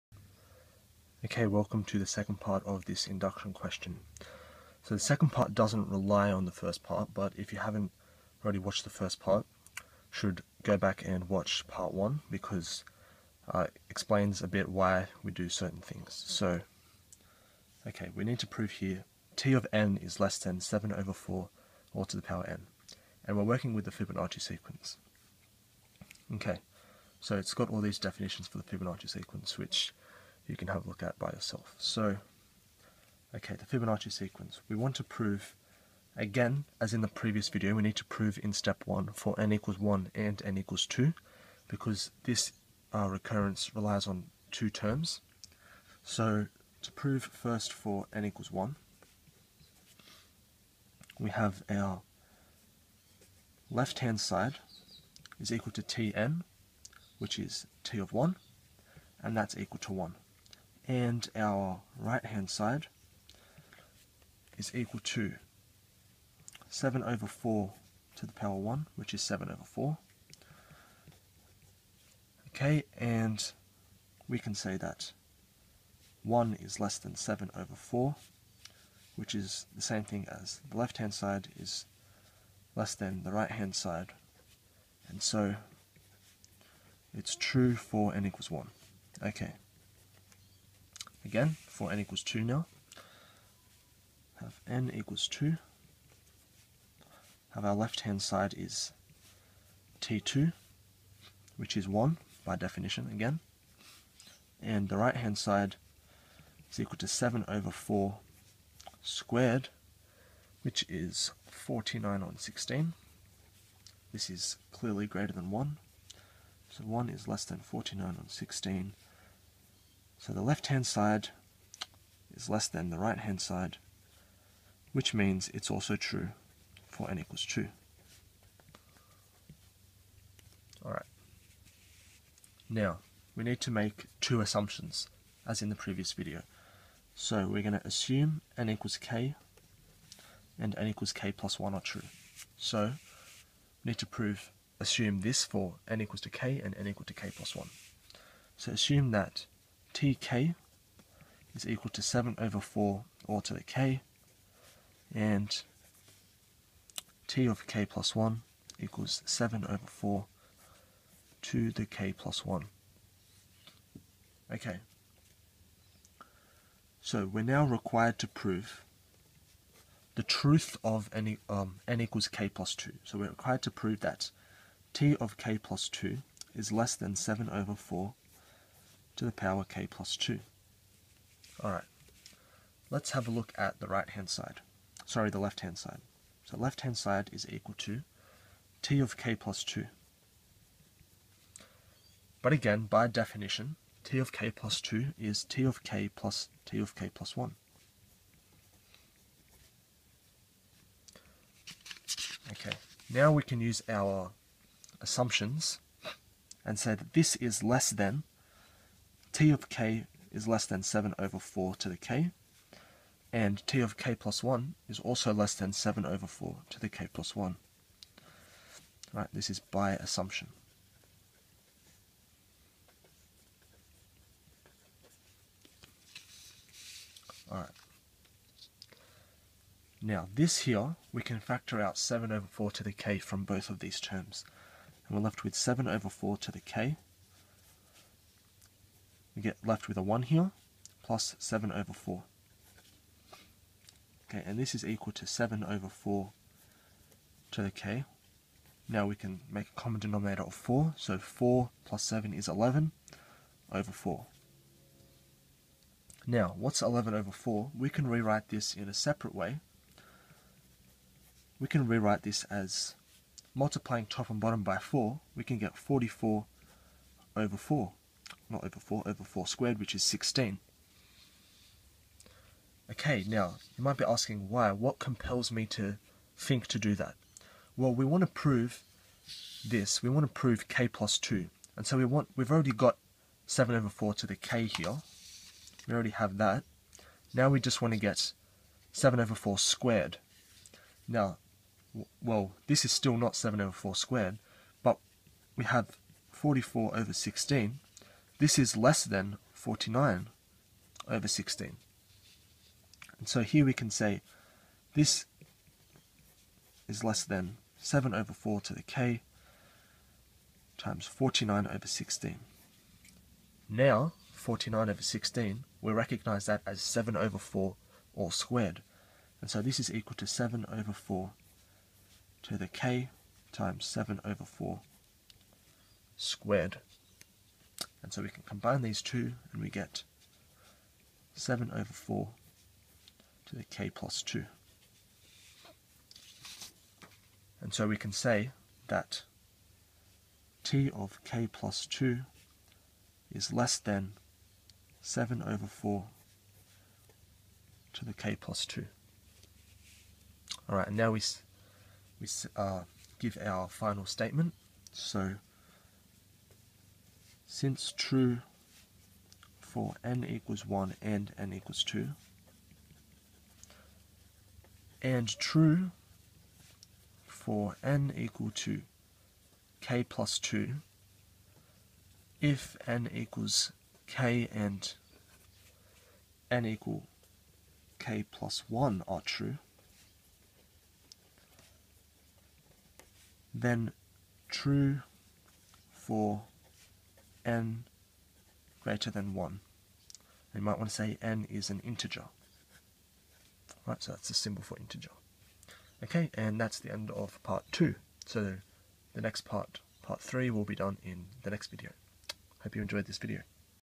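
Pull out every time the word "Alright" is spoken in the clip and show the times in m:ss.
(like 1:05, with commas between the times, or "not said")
2:10, 3:01, 3:47, 5:50.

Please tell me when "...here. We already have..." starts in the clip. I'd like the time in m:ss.
4:44.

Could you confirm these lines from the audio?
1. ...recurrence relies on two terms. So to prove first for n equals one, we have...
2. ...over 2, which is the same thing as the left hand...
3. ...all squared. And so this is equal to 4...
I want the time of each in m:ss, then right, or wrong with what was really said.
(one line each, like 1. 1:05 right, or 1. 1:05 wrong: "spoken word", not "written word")
1. 0:43 right
2. 1:17 wrong: "4", not "2"
3. 5:18 wrong: "7", not "4".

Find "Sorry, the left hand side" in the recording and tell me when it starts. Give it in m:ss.
3:05.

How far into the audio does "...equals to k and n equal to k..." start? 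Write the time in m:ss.
2:25.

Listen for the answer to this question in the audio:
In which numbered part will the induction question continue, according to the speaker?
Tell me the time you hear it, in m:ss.
6:40.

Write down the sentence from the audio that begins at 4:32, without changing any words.
Okay, now, you might be asking why, what compels me to think to do that?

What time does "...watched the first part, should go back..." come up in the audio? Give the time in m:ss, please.
0:08.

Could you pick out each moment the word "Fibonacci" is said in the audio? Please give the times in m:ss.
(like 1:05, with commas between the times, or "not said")
0:23, 0:28, 0:33.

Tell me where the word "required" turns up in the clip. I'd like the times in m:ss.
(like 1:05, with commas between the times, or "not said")
2:47, 2:53.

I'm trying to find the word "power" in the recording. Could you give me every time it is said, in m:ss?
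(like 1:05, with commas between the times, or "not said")
0:22, 1:08, 2:59.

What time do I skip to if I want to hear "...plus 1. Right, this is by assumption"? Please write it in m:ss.
3:37.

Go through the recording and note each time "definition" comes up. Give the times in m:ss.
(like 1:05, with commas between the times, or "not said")
0:27, 1:42, 3:13.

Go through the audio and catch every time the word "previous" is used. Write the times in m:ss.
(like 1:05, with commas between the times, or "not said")
0:37, 2:15.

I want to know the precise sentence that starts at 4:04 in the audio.
Okay, and this is equal to 7 over 4 to the k.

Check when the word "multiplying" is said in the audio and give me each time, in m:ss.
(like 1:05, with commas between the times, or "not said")
4:23.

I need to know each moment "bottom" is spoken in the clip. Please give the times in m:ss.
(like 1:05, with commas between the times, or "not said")
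4:24.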